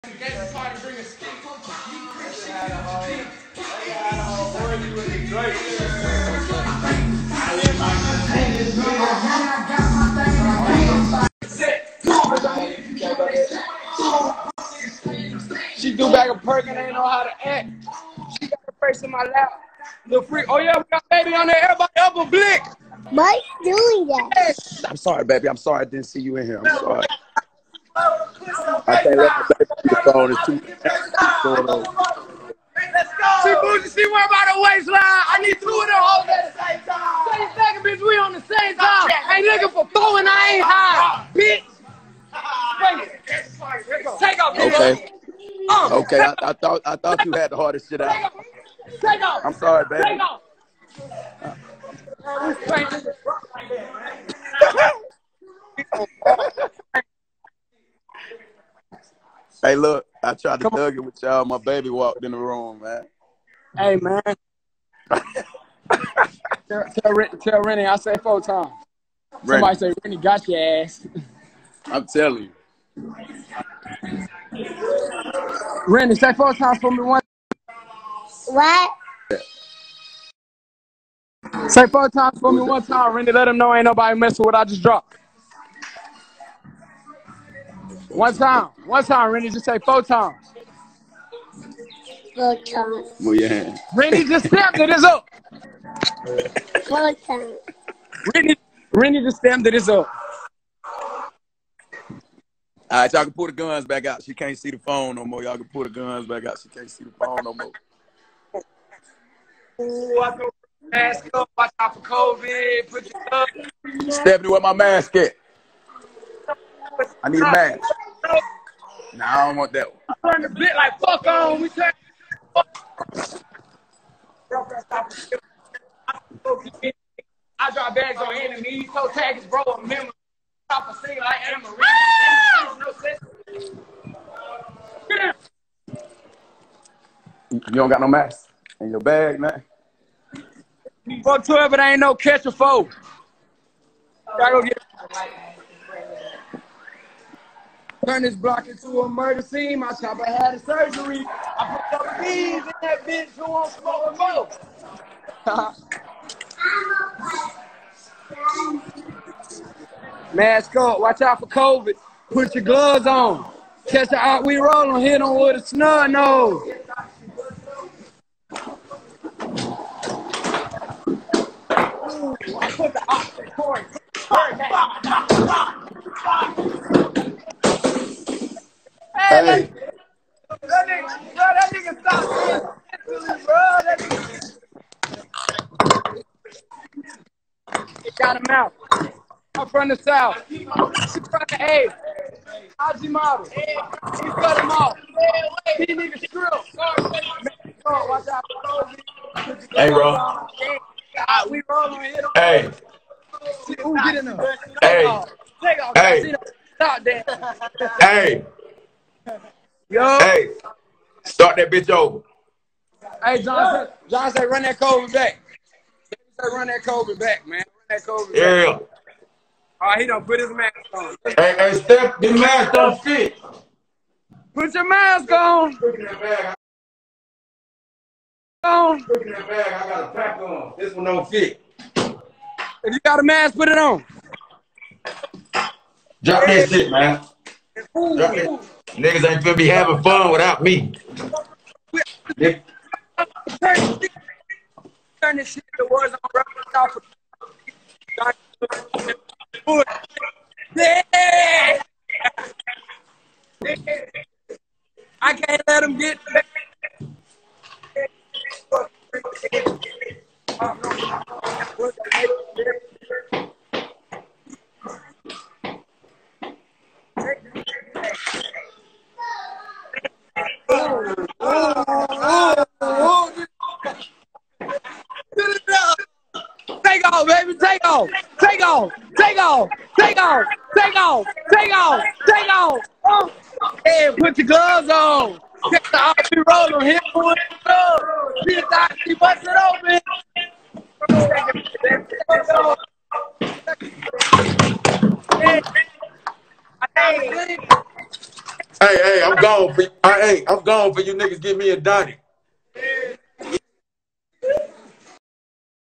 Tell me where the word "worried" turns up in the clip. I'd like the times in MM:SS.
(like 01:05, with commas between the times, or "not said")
00:34.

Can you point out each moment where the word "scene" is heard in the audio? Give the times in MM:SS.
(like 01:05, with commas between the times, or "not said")
02:29.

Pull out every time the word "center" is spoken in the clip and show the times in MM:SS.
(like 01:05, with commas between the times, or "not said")
not said.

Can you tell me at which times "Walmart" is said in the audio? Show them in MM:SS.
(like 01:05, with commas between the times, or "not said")
not said.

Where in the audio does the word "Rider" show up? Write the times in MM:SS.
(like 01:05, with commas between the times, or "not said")
not said.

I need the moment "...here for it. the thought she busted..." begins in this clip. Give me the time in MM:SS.
04:46.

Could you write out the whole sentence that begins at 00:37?
Say second, bitch, we on the same time.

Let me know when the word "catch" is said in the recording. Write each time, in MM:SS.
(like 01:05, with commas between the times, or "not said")
02:22, 02:43.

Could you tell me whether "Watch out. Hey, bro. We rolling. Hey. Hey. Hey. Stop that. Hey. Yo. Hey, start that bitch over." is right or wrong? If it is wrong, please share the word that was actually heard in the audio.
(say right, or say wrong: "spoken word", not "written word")
right.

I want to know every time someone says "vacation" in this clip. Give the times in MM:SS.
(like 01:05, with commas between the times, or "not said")
not said.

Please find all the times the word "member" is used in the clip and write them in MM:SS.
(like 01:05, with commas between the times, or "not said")
02:09.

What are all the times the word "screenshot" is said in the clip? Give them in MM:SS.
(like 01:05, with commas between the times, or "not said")
not said.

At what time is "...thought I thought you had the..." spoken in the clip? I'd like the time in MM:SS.
00:46.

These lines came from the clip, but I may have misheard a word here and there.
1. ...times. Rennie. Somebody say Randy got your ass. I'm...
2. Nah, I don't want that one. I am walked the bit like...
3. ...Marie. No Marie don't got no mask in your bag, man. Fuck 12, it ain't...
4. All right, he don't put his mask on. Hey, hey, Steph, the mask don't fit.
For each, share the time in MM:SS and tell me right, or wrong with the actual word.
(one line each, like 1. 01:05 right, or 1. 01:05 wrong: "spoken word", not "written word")
1. 01:08 wrong: "Rennie", not "Randy"
2. 01:59 wrong: "turned", not "walked"
3. 02:12 wrong: "You", not "Marie"
4. 03:39 right.